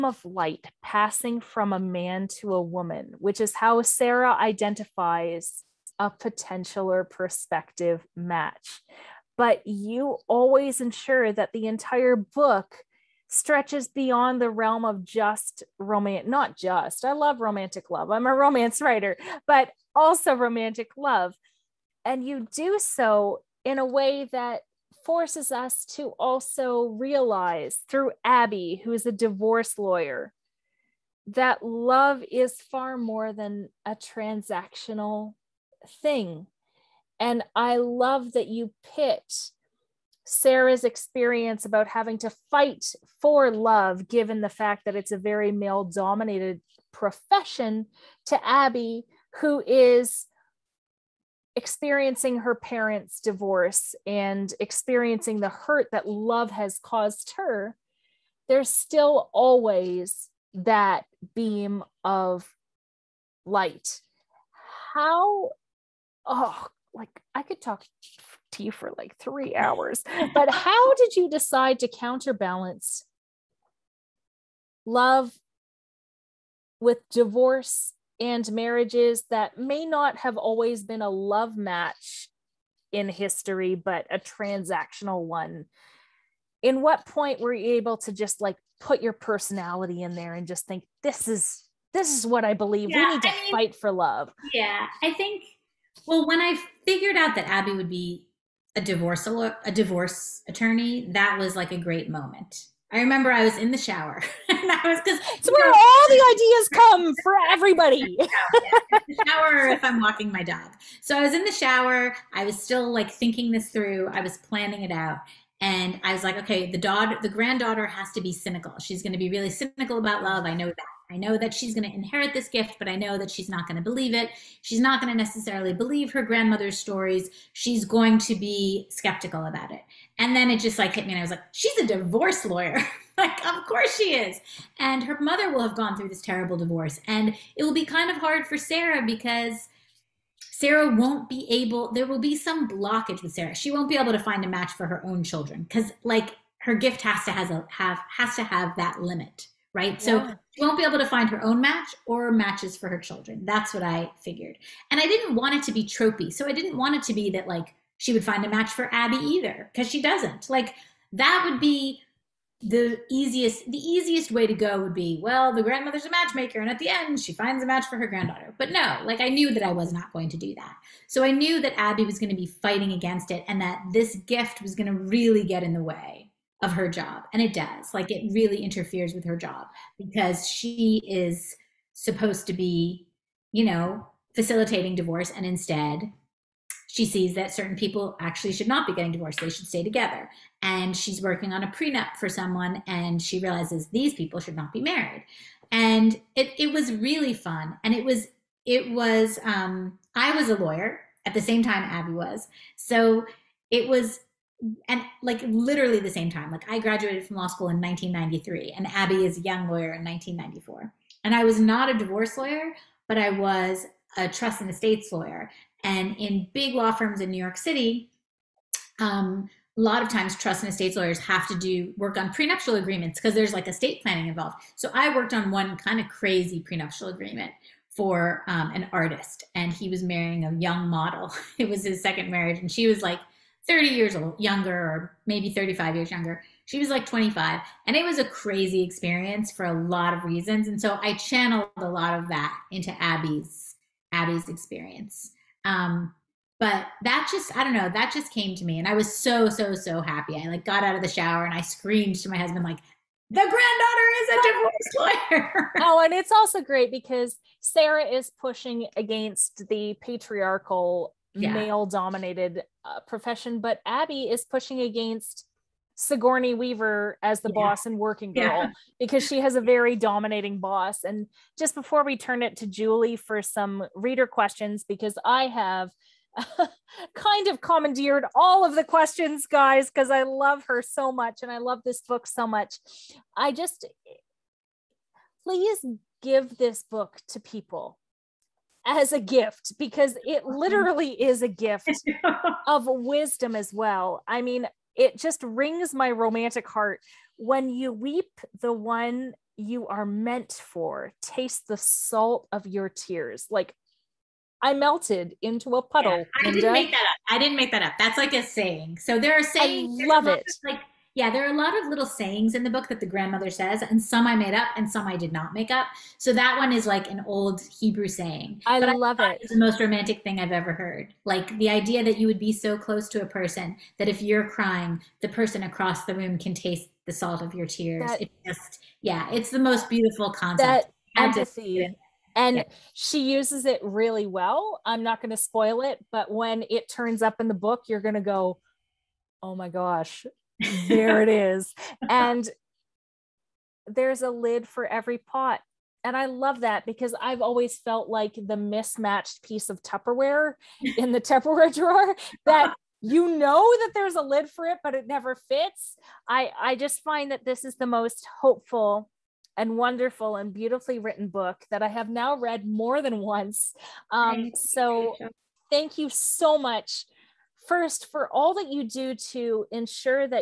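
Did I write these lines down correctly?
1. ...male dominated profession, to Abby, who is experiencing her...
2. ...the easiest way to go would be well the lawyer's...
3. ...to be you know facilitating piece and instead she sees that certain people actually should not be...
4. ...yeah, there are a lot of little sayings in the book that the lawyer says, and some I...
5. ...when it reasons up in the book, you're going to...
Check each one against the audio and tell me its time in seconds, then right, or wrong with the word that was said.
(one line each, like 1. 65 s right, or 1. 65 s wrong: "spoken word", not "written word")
1. 45 s right
2. 163 s wrong: "grandmother", not "lawyer"
3. 182 s wrong: "divorce", not "piece"
4. 311 s wrong: "grandmother", not "lawyer"
5. 336 s wrong: "turns", not "reasons".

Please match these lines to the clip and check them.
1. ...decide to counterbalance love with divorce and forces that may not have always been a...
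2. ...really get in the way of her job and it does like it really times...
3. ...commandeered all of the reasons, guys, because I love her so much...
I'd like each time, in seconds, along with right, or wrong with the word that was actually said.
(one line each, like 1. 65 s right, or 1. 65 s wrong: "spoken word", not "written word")
1. 71 s wrong: "marriages", not "forces"
2. 174 s wrong: "interferes", not "times"
3. 277 s wrong: "questions", not "reasons".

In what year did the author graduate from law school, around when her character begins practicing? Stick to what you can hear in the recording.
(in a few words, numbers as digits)
1993.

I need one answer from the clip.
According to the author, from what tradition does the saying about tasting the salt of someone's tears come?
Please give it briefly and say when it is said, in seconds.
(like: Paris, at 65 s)
Hebrew, at 317 s.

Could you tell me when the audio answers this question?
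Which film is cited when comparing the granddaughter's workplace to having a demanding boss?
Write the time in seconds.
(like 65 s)
267 s.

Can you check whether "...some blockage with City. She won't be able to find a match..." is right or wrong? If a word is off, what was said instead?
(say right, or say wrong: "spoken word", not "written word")
wrong: "Sarah", not "City".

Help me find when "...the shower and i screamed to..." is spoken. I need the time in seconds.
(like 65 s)
251 s.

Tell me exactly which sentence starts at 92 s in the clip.
Yeah, we need to I mean, fight for love.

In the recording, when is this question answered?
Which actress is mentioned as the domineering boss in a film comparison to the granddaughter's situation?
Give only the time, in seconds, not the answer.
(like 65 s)
266 s.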